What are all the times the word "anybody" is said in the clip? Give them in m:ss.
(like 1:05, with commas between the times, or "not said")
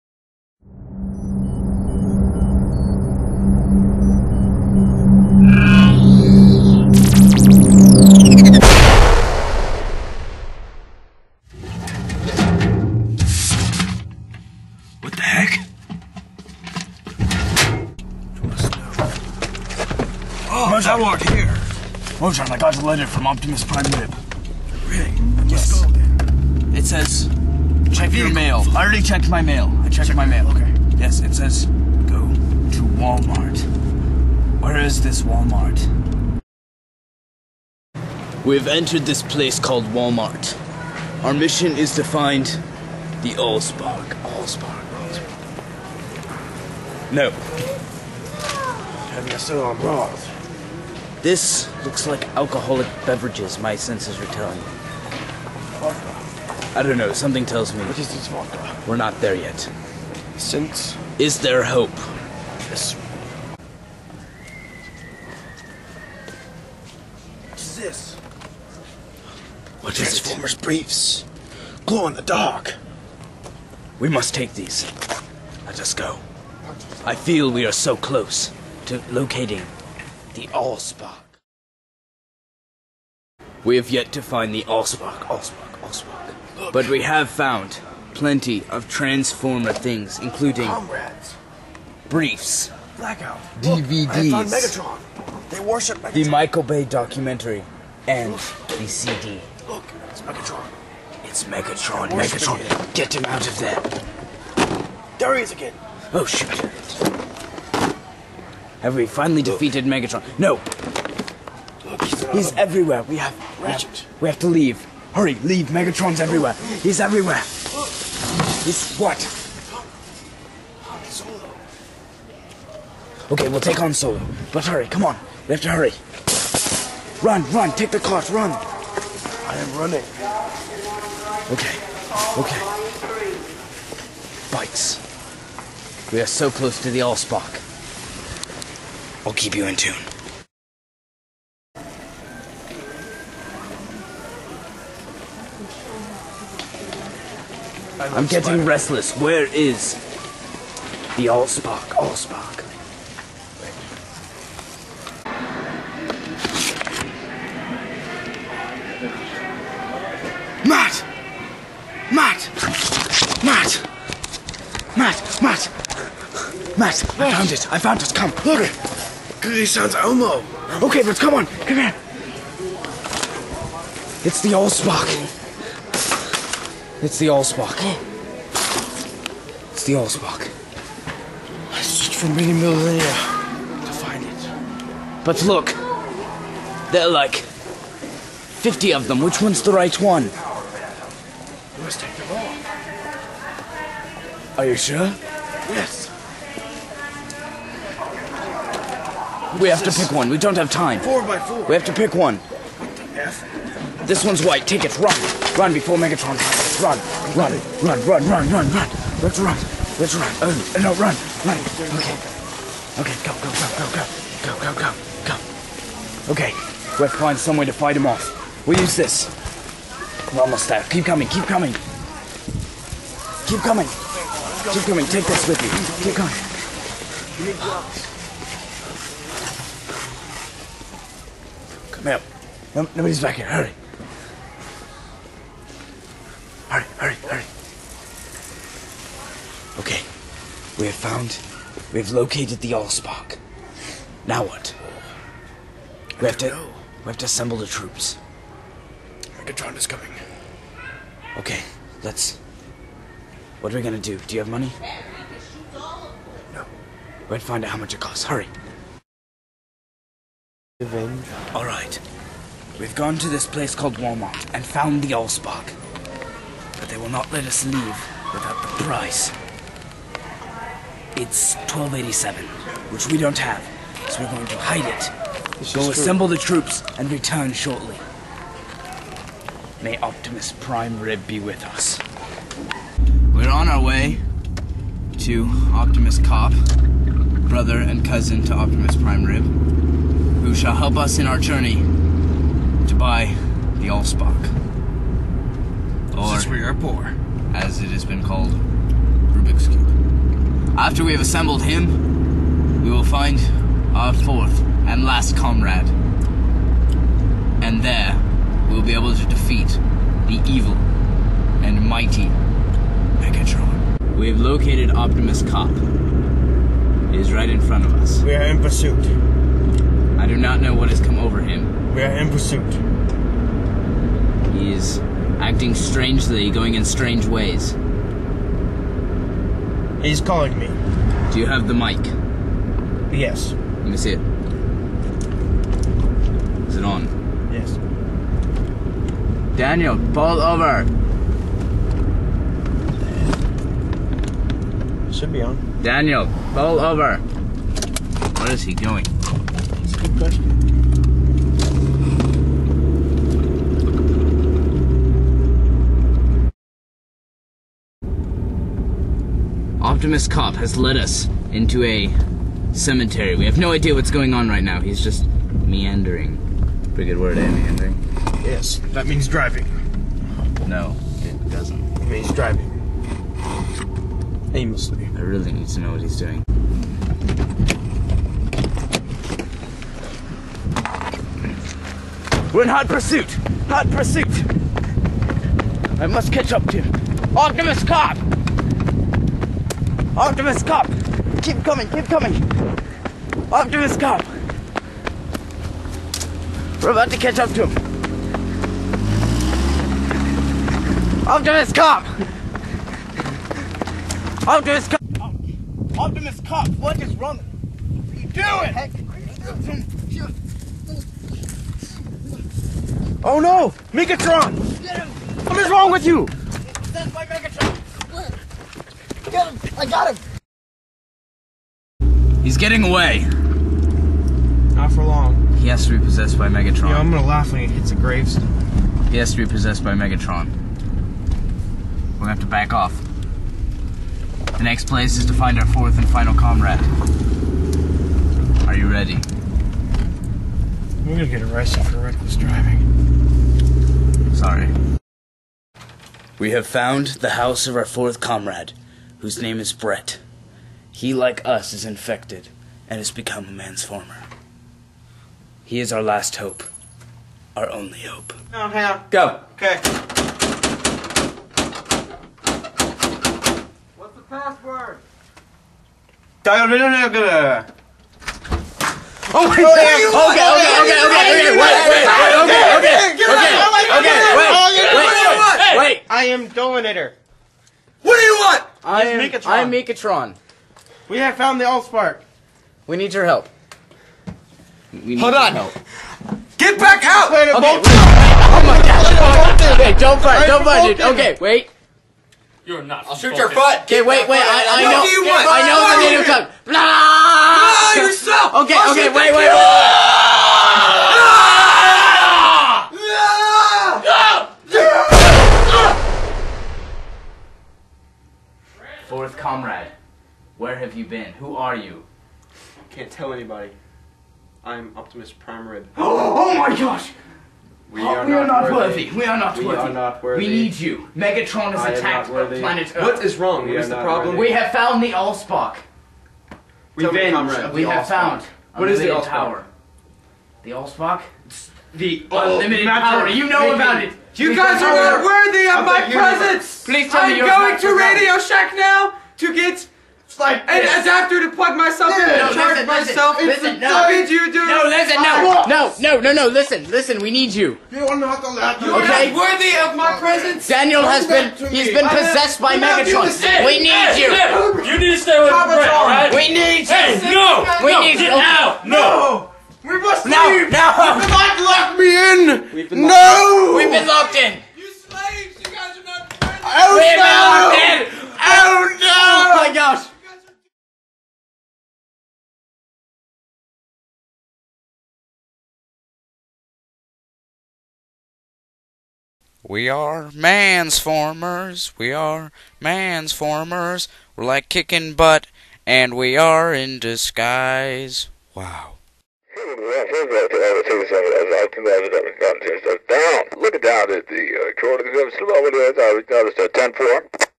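8:33.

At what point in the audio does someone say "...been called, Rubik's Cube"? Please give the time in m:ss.
4:58.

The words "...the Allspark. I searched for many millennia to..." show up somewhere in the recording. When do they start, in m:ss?
2:59.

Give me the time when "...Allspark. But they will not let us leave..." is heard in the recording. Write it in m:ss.
4:25.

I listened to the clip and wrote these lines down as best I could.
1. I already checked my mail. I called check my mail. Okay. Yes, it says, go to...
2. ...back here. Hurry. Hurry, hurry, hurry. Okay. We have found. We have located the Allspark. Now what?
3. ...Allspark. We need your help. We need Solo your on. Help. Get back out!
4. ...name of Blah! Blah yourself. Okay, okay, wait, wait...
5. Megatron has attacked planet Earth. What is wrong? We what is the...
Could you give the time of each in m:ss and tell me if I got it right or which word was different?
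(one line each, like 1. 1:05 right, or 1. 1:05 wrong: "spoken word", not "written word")
1. 0:28 wrong: "checked", not "called"
2. 3:53 right
3. 8:01 wrong: "Hold", not "Solo"
4. 8:16 right
5. 8:41 right.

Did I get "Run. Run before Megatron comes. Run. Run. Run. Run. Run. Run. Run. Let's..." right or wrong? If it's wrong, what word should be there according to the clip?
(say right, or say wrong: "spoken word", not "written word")
right.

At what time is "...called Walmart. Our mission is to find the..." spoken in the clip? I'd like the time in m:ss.
0:39.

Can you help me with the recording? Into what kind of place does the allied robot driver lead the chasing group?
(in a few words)
A cemetery.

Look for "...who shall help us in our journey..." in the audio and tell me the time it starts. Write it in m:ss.
4:50.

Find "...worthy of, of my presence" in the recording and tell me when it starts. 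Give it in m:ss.
8:55.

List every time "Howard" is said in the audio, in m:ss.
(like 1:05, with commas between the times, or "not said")
0:21.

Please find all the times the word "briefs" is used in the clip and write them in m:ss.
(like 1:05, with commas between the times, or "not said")
1:10, 1:32.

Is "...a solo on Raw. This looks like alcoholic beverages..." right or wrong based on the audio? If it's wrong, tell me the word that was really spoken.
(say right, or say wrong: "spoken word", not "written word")
right.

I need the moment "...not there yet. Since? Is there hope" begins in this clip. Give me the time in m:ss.
0:58.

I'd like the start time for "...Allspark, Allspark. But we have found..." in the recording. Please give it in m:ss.
1:25.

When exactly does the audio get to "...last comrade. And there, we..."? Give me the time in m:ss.
5:05.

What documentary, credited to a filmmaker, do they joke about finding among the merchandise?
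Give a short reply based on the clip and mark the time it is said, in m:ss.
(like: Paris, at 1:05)
The Michael Bay documentary, at 1:36.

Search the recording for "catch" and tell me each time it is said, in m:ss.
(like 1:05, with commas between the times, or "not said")
6:26, 6:37.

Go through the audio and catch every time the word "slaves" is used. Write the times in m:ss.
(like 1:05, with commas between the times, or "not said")
9:24.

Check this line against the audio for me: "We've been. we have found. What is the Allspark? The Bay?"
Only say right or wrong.
wrong.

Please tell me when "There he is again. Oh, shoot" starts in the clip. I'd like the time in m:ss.
1:45.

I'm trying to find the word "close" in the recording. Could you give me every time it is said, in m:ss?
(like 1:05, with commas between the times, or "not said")
1:17, 2:16.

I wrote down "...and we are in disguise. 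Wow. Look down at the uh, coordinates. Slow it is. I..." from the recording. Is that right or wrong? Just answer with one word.
right.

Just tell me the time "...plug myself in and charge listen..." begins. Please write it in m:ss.
9:01.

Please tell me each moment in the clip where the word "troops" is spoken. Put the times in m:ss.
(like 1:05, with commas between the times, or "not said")
4:07, 4:36.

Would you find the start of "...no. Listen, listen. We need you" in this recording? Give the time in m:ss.
9:06.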